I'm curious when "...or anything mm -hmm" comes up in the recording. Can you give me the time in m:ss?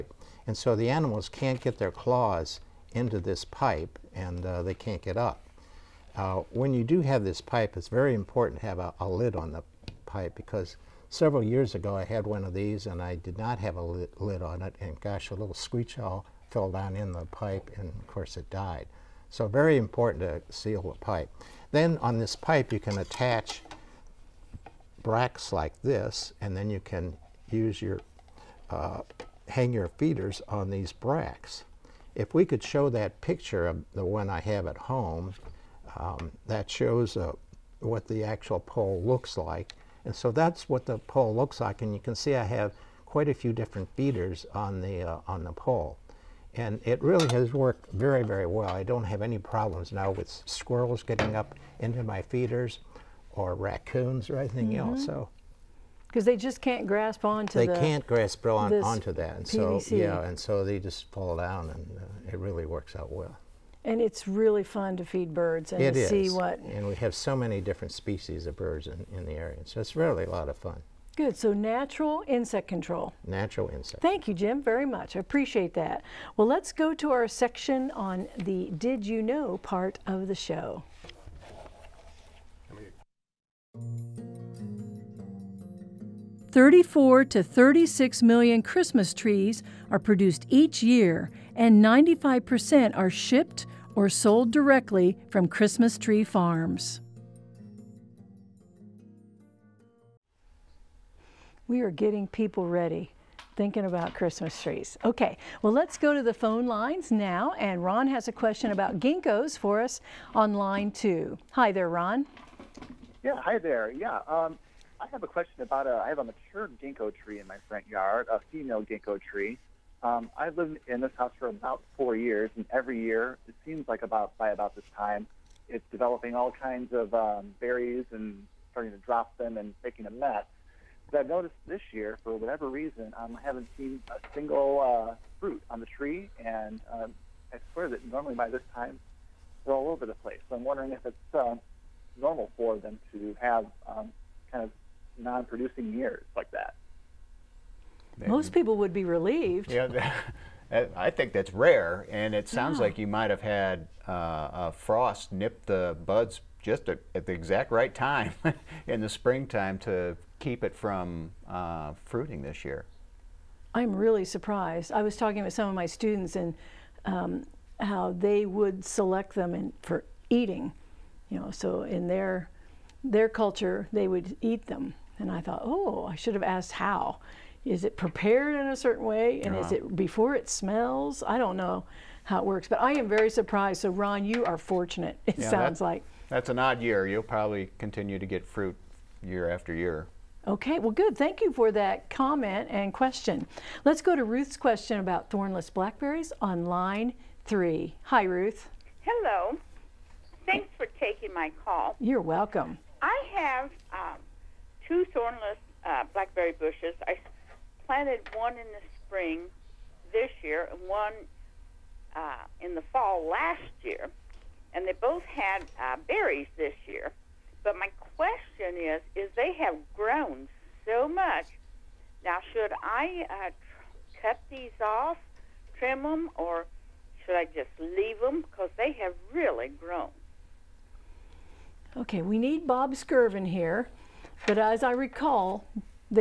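0:54.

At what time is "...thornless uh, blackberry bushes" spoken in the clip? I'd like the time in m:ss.
3:25.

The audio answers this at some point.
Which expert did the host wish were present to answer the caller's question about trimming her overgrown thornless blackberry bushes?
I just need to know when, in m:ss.
3:52.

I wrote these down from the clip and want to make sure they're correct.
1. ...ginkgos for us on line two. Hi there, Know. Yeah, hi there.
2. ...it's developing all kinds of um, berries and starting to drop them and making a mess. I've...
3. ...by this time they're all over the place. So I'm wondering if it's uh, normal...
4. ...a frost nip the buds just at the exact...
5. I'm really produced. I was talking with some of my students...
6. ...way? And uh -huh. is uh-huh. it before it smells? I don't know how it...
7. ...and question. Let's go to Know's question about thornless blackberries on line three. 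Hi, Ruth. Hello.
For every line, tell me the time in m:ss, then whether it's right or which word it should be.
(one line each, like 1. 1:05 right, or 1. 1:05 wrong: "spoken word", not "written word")
1. 1:48 wrong: "Ron", not "Know"
2. 2:05 right
3. 2:18 right
4. 2:34 right
5. 2:43 wrong: "surprised", not "produced"
6. 2:59 right
7. 3:12 wrong: "Ruth", not "Know".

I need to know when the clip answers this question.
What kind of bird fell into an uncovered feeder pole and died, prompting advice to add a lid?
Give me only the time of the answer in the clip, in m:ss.
0:15.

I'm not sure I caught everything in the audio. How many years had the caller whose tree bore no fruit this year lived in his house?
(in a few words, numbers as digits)
4.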